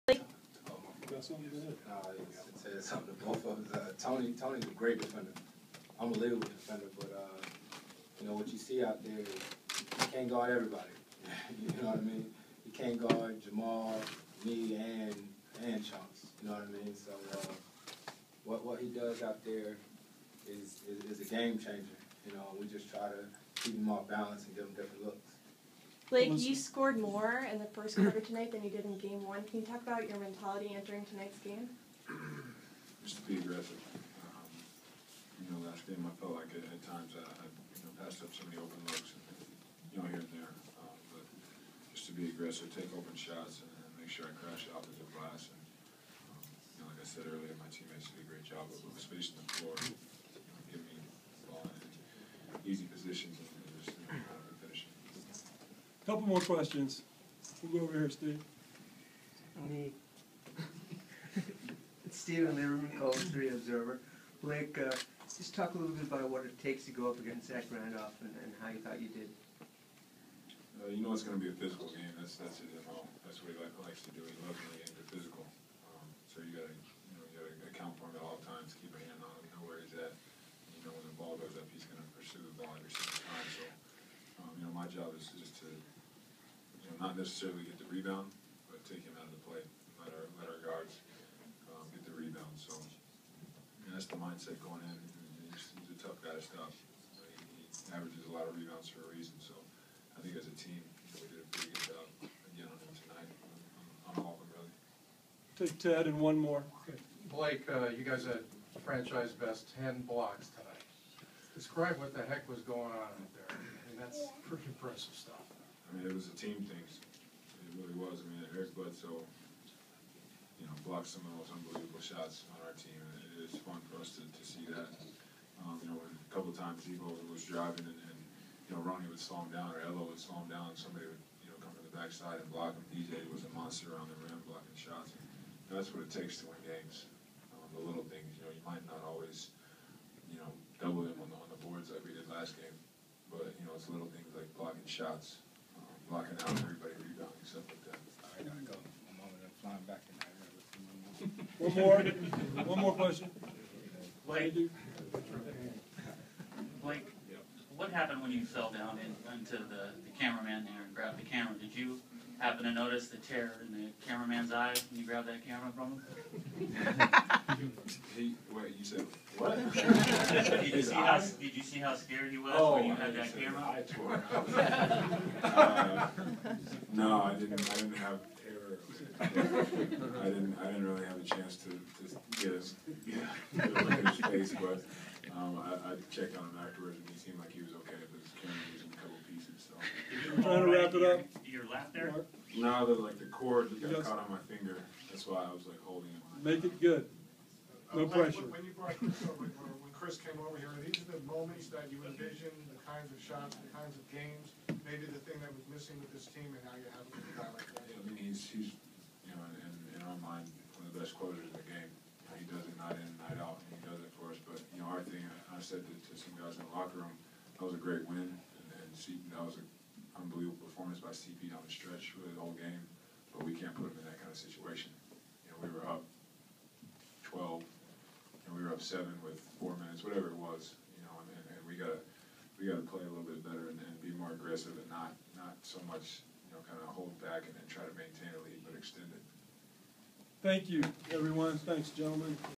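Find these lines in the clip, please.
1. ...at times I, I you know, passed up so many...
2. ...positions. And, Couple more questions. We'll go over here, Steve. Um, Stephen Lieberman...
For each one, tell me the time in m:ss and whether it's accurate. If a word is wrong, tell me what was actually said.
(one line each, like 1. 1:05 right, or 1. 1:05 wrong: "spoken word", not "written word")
1. 0:36 right
2. 0:52 right.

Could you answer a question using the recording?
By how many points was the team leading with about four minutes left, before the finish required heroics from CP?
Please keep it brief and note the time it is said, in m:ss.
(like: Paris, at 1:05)
7, at 3:48.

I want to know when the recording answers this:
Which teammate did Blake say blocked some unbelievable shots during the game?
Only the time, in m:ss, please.
1:58.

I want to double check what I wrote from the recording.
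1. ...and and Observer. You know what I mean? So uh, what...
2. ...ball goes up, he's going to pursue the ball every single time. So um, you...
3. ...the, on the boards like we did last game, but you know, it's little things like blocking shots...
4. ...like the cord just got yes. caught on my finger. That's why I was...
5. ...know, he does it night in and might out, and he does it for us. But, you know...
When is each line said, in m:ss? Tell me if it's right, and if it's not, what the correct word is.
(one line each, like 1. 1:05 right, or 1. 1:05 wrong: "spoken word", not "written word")
1. 0:14 wrong: "Chunks", not "Observer"
2. 1:21 right
3. 2:21 right
4. 3:13 right
5. 3:32 wrong: "night", not "might".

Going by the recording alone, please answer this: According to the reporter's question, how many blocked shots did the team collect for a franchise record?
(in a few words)
10.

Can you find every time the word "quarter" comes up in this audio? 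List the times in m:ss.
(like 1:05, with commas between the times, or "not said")
0:27.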